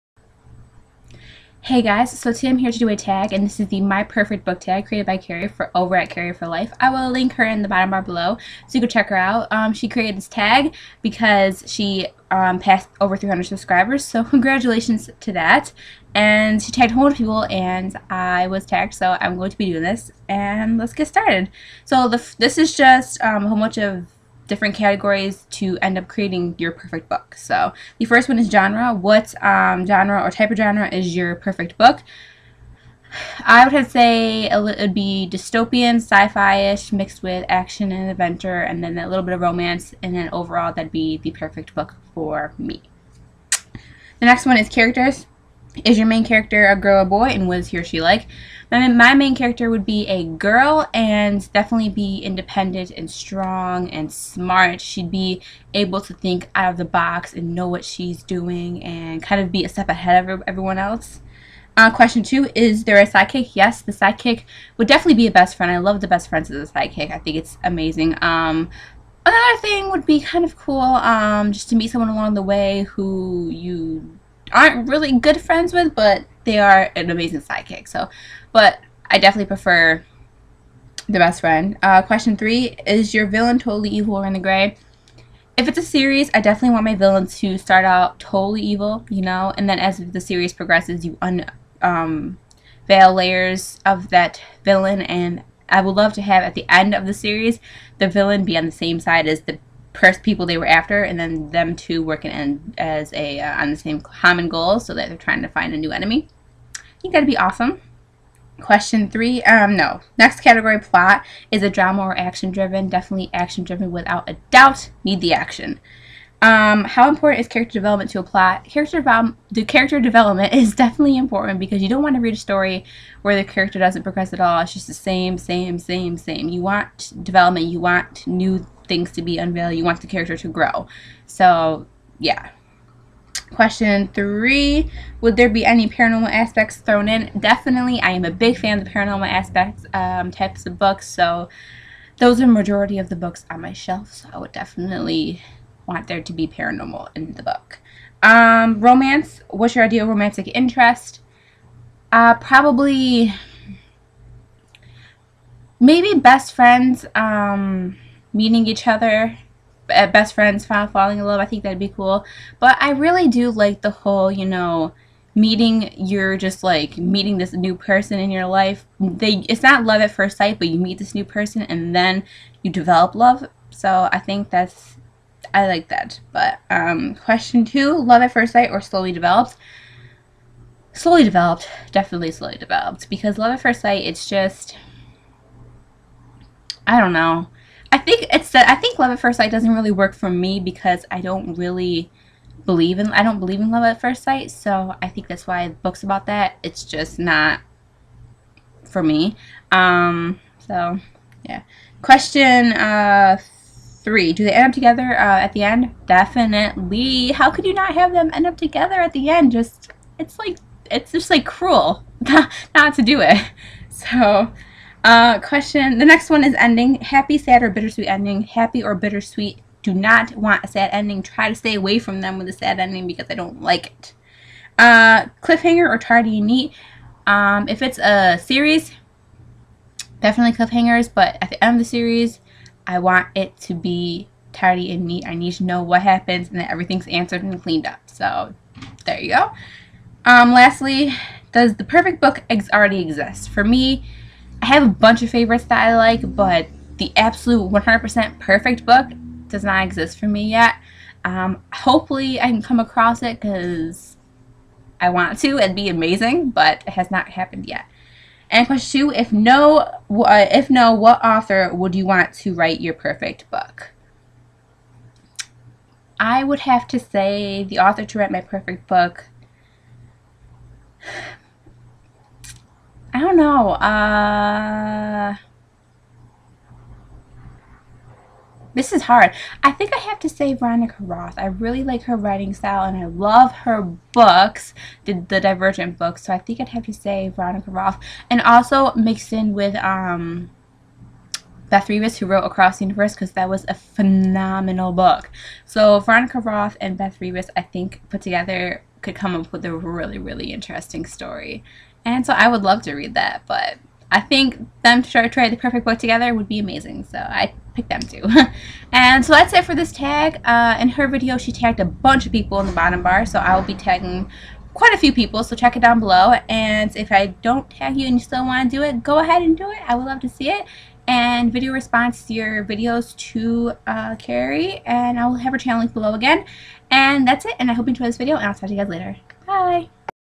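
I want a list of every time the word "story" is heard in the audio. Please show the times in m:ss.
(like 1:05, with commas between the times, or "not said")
2:02, 5:01.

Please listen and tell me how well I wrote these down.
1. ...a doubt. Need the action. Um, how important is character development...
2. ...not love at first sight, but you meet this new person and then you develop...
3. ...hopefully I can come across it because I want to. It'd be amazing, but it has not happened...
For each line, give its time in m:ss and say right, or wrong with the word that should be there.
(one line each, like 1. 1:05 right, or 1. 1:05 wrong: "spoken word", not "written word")
1. 1:54 right
2. 2:49 right
3. 4:11 right.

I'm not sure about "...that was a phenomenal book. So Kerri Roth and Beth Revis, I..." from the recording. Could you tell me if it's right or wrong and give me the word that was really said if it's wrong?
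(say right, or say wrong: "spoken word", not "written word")
wrong: "Veronica", not "Kerri".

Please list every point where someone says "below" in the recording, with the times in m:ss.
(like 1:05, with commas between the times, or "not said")
0:08, 5:15, 5:25.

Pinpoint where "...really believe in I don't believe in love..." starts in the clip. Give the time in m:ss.
3:11.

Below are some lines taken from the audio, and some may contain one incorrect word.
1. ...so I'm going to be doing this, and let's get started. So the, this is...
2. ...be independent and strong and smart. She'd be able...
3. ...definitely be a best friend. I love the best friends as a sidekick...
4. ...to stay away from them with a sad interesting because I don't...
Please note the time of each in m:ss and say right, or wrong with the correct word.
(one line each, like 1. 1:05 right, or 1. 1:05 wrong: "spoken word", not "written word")
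1. 0:18 right
2. 0:51 right
3. 1:04 right
4. 3:41 wrong: "ending", not "interesting".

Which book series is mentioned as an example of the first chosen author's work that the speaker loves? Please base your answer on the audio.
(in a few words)
Divergent.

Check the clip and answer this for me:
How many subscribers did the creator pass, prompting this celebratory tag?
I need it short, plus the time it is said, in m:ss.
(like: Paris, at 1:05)
300, at 0:13.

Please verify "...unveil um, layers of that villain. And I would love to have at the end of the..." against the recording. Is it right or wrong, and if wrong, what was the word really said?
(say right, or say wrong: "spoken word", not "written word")
right.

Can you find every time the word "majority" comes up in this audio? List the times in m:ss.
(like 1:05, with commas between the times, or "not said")
2:22.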